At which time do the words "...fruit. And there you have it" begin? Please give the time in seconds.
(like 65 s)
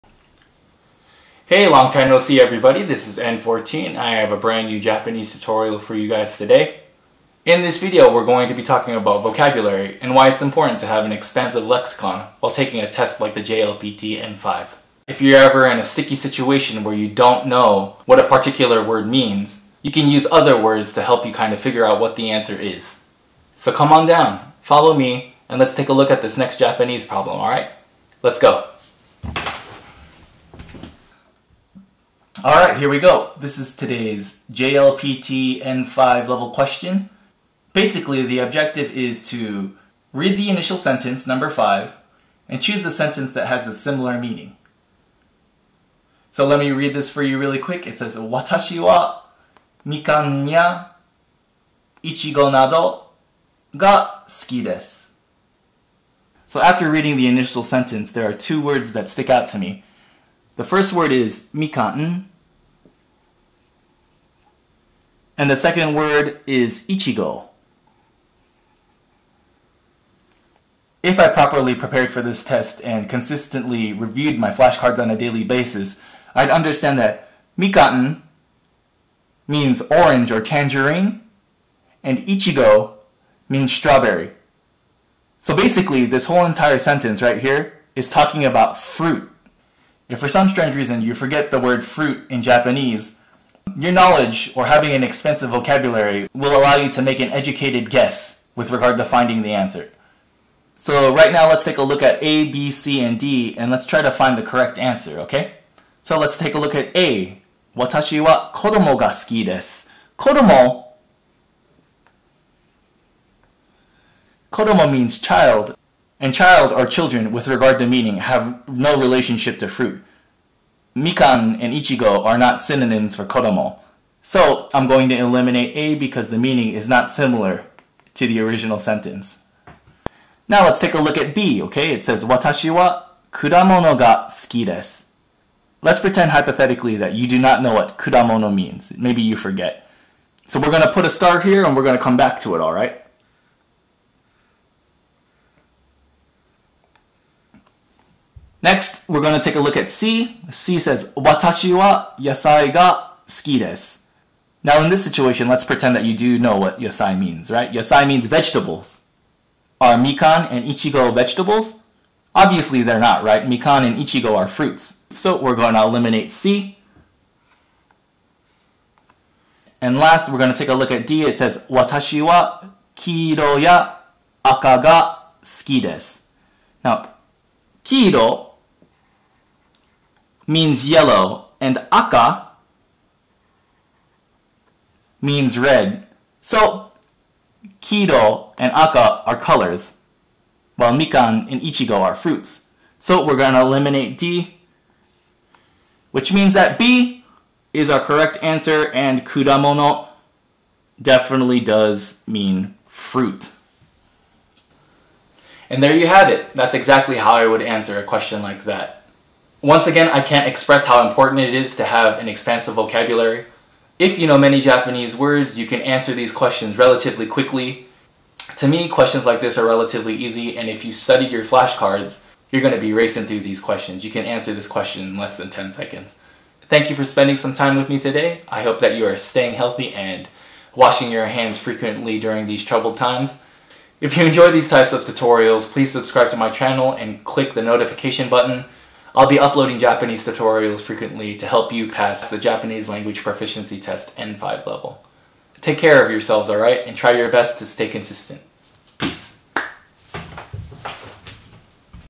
202 s.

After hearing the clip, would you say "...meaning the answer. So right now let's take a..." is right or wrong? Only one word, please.
wrong.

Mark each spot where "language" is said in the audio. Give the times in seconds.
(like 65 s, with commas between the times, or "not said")
242 s.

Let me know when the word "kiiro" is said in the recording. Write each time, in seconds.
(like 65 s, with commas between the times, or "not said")
172 s, 177 s, 187 s.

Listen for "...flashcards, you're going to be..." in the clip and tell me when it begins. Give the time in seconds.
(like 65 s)
221 s.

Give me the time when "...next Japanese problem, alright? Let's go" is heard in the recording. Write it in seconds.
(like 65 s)
26 s.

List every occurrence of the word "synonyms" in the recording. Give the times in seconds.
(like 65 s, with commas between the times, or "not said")
122 s.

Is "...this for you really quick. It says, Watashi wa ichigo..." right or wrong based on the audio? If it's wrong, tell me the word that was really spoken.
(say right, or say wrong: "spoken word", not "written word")
right.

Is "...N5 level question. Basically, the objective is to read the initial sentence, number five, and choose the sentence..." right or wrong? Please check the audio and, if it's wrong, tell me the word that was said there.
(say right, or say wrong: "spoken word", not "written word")
right.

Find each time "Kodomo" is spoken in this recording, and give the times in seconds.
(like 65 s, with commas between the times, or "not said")
114 s, 123 s.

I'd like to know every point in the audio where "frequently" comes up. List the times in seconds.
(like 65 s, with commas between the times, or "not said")
231 s, 240 s.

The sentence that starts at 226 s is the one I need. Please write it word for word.
Thank you for spending some time with me today.